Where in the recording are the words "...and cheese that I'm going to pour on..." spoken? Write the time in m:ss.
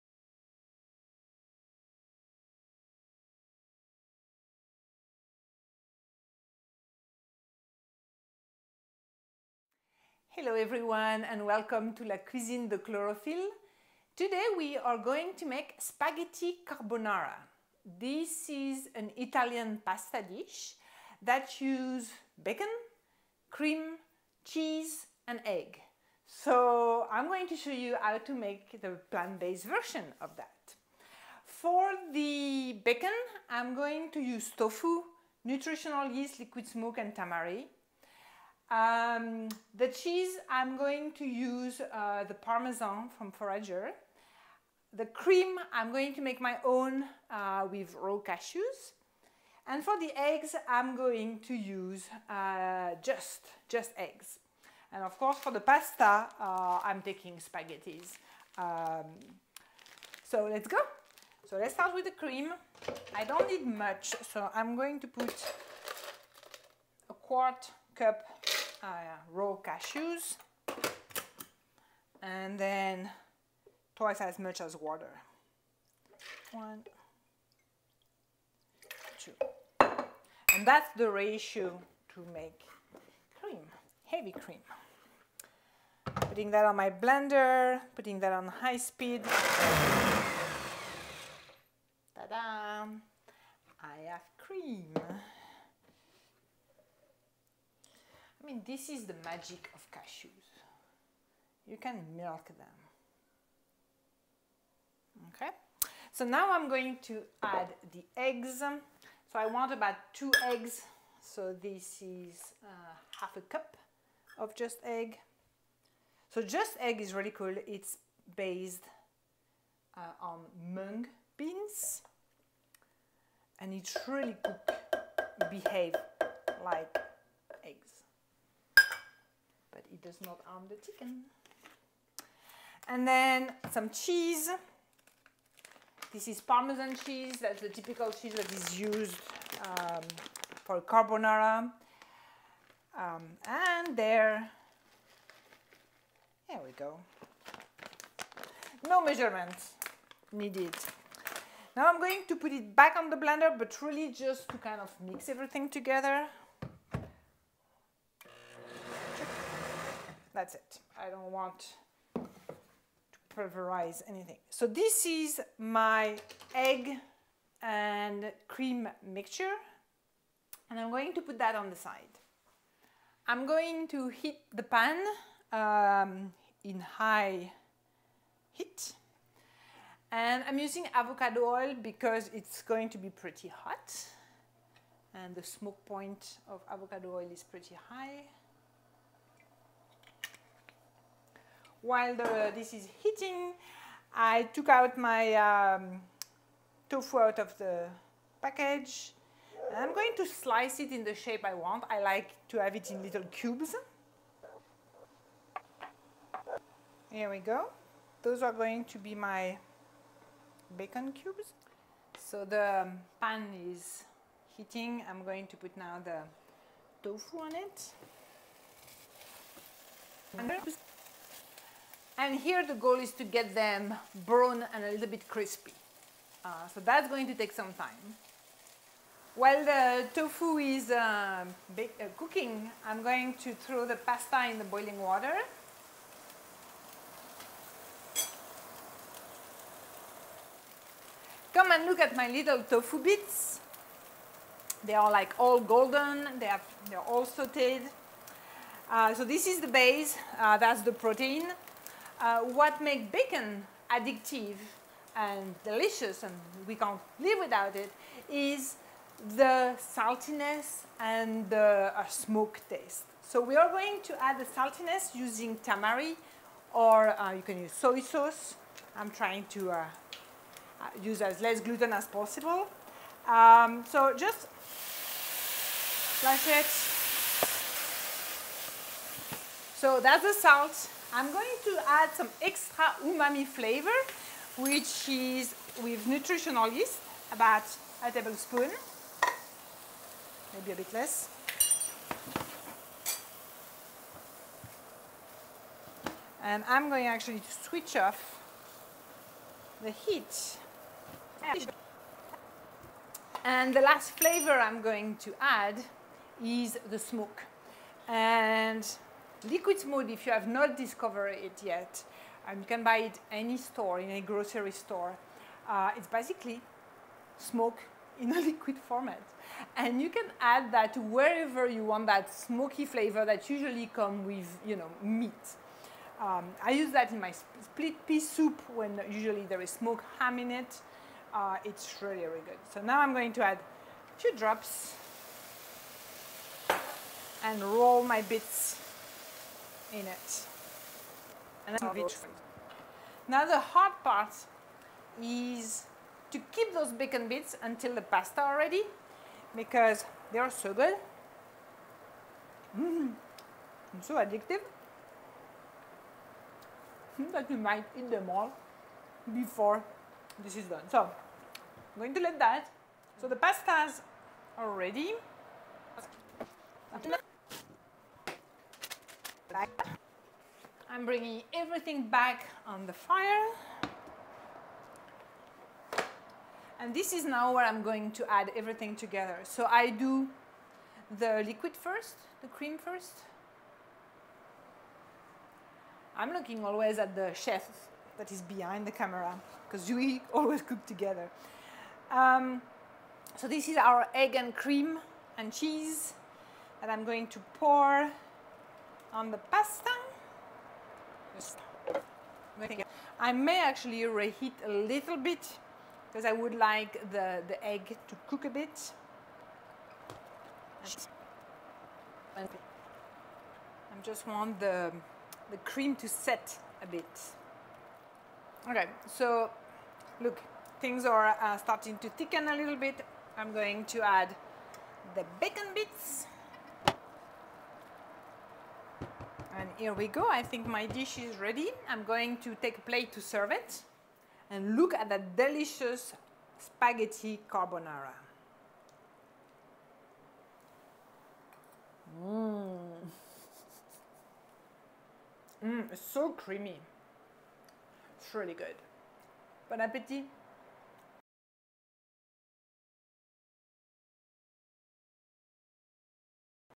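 6:35.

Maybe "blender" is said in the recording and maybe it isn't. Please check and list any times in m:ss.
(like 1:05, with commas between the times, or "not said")
1:26, 2:33.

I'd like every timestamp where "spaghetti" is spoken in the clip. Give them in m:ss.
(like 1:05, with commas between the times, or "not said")
0:15, 0:57, 7:16.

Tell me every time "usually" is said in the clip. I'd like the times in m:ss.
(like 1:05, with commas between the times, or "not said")
5:23, 5:29.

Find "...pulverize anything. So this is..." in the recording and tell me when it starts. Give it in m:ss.
2:43.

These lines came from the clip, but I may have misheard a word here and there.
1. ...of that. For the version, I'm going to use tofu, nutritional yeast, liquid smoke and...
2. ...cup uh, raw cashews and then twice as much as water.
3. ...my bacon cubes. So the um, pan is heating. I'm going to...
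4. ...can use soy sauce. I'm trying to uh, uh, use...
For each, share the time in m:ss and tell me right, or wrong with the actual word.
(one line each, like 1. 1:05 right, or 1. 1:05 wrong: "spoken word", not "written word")
1. 0:30 wrong: "bacon", not "version"
2. 1:07 right
3. 3:29 right
4. 4:27 right.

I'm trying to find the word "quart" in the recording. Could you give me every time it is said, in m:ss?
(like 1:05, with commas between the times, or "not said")
1:07.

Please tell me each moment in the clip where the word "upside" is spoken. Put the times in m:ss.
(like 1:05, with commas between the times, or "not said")
not said.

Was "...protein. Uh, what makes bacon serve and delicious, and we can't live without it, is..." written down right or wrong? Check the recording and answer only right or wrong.
wrong.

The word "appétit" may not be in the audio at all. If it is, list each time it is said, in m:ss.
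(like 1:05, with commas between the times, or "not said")
7:29.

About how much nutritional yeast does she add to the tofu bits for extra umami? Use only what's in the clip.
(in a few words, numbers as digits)
A tablespoon.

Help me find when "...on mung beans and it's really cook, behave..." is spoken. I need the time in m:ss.
2:00.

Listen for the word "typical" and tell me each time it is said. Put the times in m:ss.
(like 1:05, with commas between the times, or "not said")
2:17.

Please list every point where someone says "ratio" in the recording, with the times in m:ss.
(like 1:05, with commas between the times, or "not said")
1:21.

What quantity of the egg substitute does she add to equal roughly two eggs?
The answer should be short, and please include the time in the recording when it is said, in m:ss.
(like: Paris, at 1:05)
Half a cup, at 1:53.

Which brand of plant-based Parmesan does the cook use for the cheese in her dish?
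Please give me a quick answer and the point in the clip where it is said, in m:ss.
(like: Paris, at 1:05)
Forager, at 0:43.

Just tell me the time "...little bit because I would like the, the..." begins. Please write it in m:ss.
6:44.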